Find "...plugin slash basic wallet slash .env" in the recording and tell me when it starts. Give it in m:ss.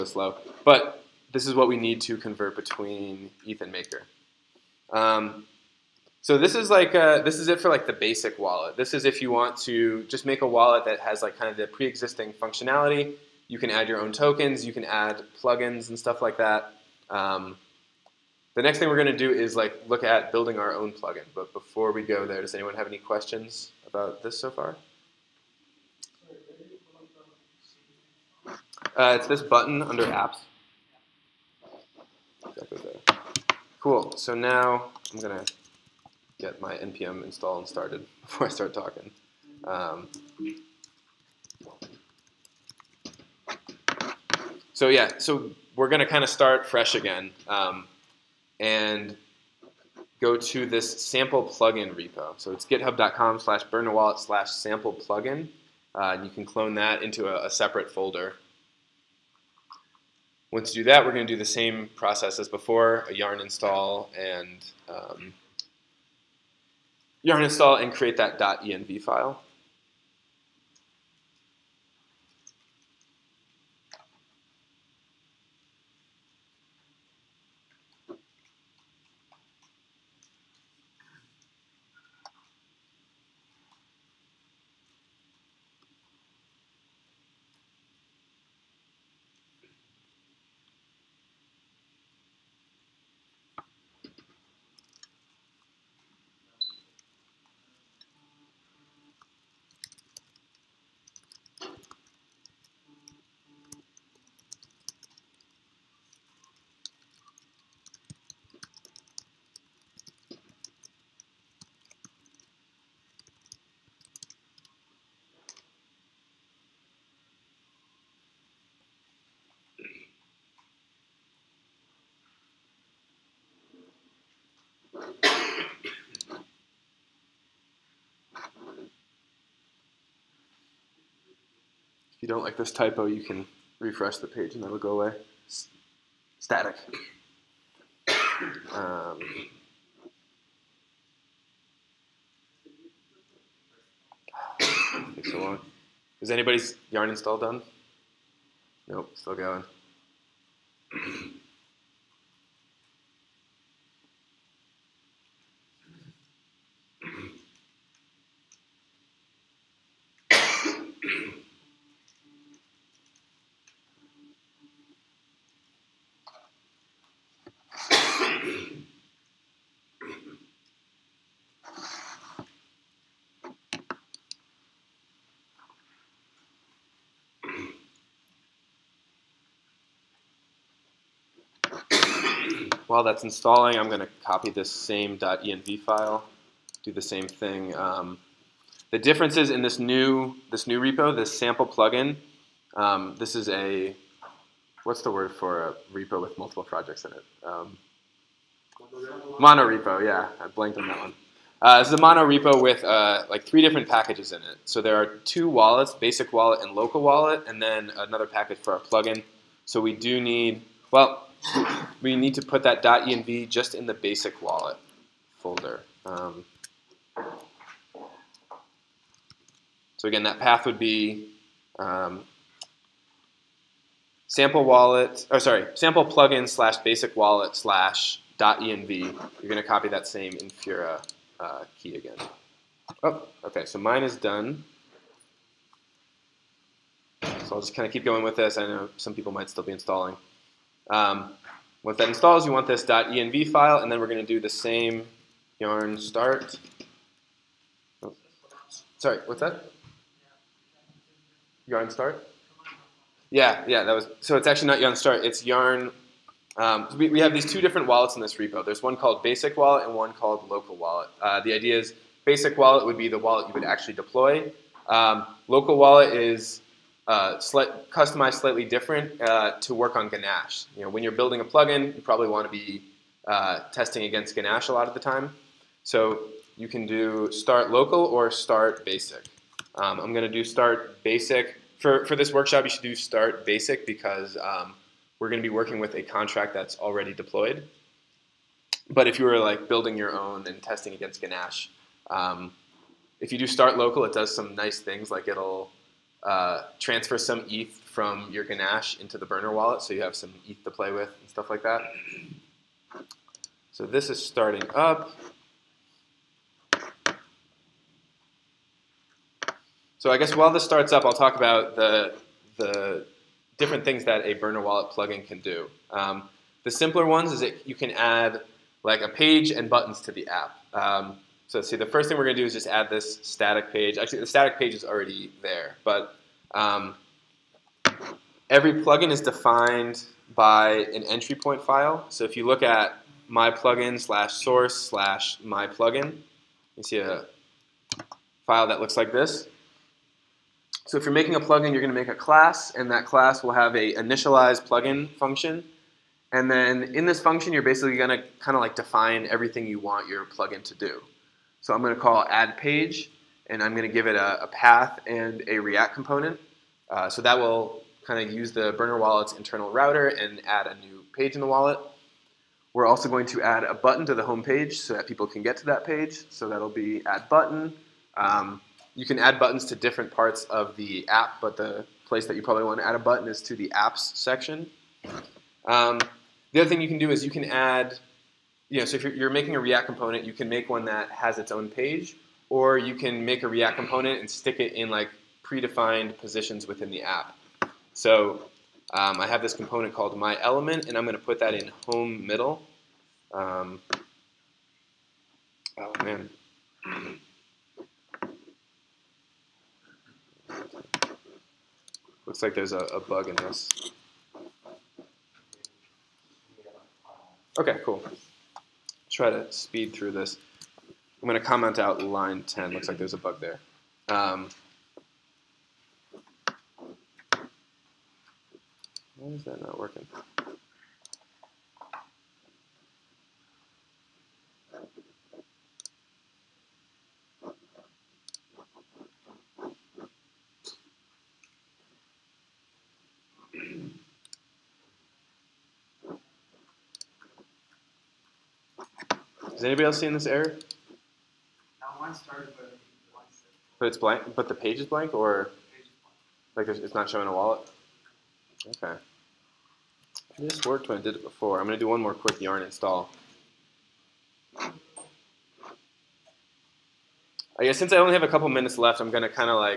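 3:46.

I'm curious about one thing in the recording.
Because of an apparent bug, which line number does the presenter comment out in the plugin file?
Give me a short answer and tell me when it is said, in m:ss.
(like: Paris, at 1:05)
10, at 6:52.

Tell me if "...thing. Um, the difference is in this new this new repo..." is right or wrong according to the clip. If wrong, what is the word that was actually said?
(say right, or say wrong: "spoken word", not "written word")
right.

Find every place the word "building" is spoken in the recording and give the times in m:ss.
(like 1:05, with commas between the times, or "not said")
0:20, 4:31, 4:49.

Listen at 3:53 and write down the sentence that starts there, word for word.
Oh, okay, so mine is done.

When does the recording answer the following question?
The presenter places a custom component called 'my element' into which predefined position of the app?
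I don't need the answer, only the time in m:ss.
6:31.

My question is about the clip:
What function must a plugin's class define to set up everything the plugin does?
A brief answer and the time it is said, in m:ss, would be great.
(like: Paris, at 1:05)
initialize plugin, at 5:43.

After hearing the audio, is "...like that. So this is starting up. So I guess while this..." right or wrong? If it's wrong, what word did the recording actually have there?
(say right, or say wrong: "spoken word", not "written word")
right.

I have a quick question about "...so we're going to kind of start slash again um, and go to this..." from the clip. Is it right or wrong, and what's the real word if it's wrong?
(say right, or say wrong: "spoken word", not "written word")
wrong: "fresh", not "slash".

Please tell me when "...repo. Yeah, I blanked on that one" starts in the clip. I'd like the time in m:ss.
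3:19.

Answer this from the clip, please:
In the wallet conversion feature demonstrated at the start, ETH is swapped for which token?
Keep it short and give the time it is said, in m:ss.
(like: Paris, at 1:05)
Maker, at 0:03.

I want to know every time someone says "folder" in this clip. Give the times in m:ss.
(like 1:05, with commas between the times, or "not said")
0:57, 3:35.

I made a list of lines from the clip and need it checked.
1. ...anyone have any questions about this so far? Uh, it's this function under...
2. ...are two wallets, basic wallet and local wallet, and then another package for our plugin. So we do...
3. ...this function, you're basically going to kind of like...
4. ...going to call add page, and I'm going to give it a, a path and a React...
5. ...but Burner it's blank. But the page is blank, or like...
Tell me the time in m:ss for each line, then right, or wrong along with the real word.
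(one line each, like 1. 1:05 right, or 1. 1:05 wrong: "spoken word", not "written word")
1. 0:22 wrong: "button", not "function"
2. 3:24 right
3. 5:47 right
4. 5:51 right
5. 7:22 wrong: "But", not "Burner".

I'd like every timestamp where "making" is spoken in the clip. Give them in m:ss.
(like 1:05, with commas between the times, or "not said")
5:41, 6:19.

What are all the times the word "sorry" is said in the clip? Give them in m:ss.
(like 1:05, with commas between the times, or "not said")
3:45, 4:08.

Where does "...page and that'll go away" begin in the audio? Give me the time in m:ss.
2:14.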